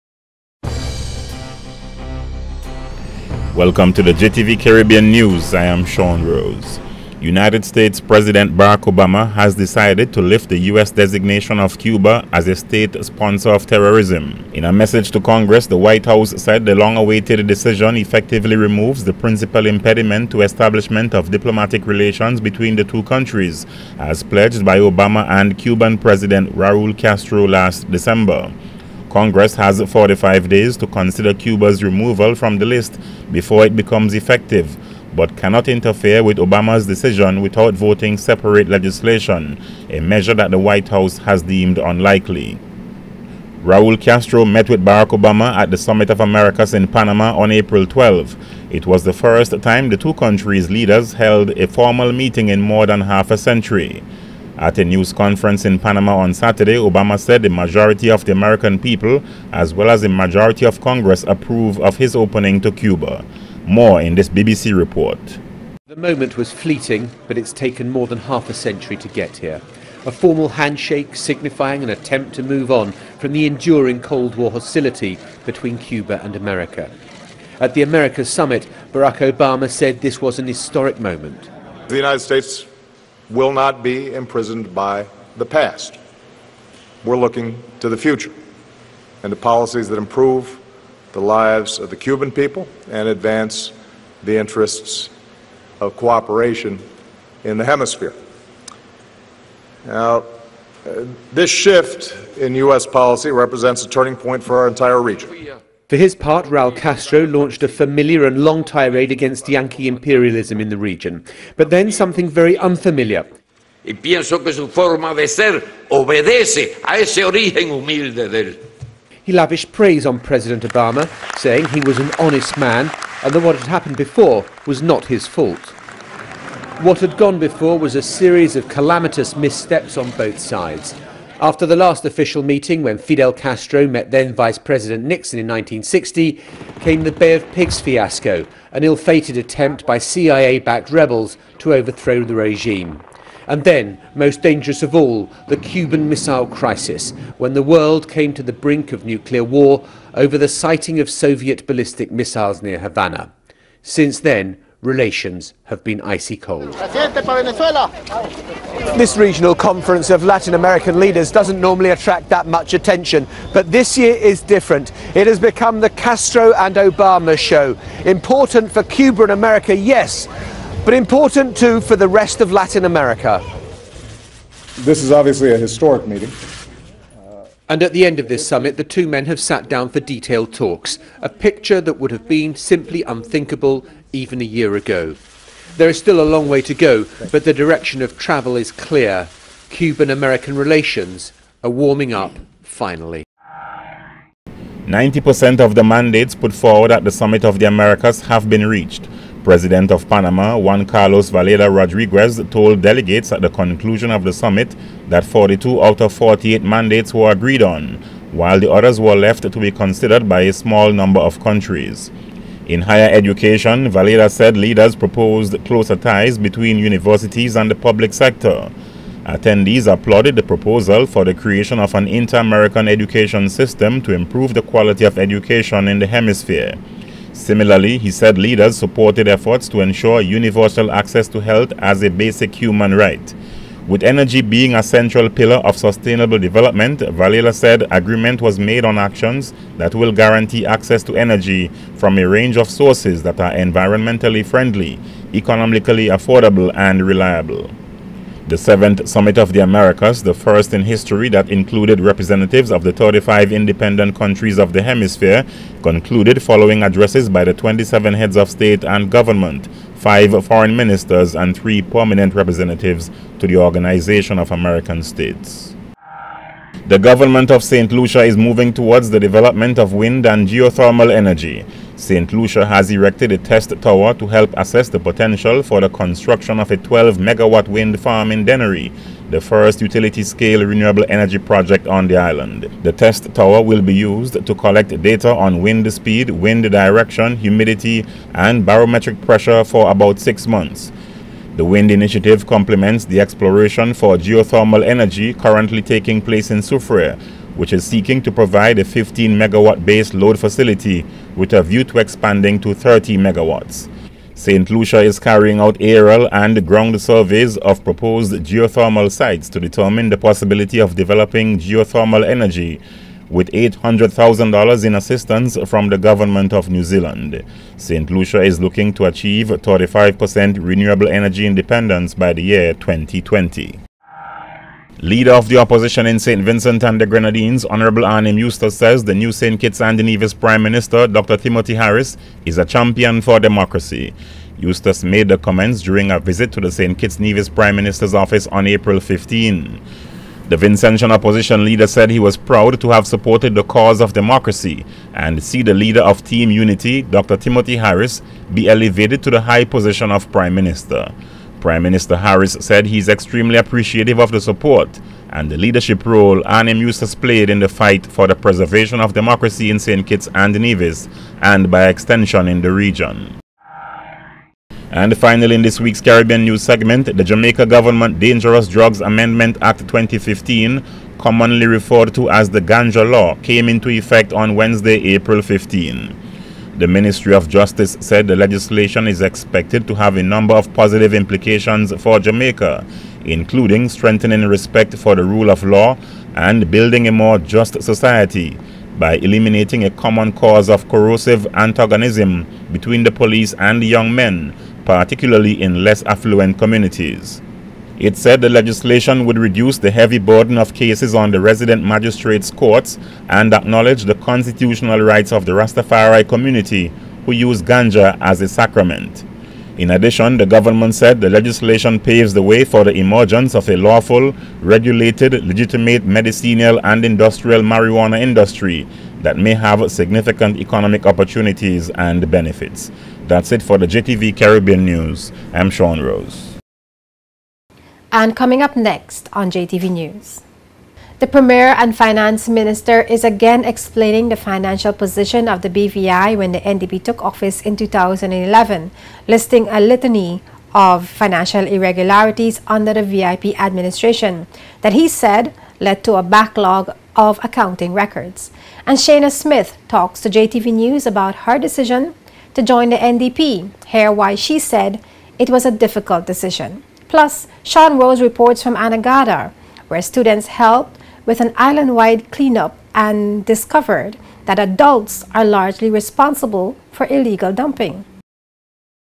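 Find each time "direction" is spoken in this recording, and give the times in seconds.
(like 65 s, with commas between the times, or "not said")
187 s, 286 s.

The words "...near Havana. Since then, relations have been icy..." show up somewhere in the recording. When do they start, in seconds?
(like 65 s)
152 s.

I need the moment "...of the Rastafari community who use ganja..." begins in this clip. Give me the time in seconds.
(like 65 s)
405 s.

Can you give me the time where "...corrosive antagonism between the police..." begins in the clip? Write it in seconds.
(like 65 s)
390 s.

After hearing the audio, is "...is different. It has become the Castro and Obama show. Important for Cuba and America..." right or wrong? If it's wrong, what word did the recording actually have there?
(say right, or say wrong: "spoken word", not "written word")
right.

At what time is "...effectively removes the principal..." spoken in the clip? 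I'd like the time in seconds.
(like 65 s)
17 s.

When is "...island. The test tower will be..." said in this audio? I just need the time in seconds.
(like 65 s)
282 s.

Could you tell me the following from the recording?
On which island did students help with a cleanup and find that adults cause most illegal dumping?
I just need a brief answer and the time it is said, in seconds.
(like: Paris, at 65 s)
Anegada, at 458 s.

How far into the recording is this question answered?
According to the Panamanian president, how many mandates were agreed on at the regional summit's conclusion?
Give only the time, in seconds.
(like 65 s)
205 s.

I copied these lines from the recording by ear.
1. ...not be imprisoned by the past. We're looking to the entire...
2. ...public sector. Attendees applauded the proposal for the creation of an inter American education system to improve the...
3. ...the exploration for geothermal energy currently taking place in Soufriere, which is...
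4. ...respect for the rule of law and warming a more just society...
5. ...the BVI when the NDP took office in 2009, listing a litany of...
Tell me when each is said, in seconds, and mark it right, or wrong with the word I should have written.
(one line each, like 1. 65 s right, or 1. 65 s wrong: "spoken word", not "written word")
1. 83 s wrong: "future", not "entire"
2. 217 s right
3. 293 s right
4. 384 s wrong: "building", not "warming"
5. 435 s wrong: "2011", not "2009".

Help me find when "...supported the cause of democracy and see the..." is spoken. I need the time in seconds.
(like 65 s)
343 s.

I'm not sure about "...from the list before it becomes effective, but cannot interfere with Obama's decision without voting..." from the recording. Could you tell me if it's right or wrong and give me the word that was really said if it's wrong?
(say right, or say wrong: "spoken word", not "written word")
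right.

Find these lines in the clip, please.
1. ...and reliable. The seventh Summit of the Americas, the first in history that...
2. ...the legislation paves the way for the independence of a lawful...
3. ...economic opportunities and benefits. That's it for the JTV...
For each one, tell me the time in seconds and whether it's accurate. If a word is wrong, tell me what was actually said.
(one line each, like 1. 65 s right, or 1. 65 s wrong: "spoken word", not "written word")
1. 246 s right
2. 411 s wrong: "emergence", not "independence"
3. 420 s right.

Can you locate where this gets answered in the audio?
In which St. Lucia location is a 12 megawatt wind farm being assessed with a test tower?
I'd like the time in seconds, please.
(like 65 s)
278 s.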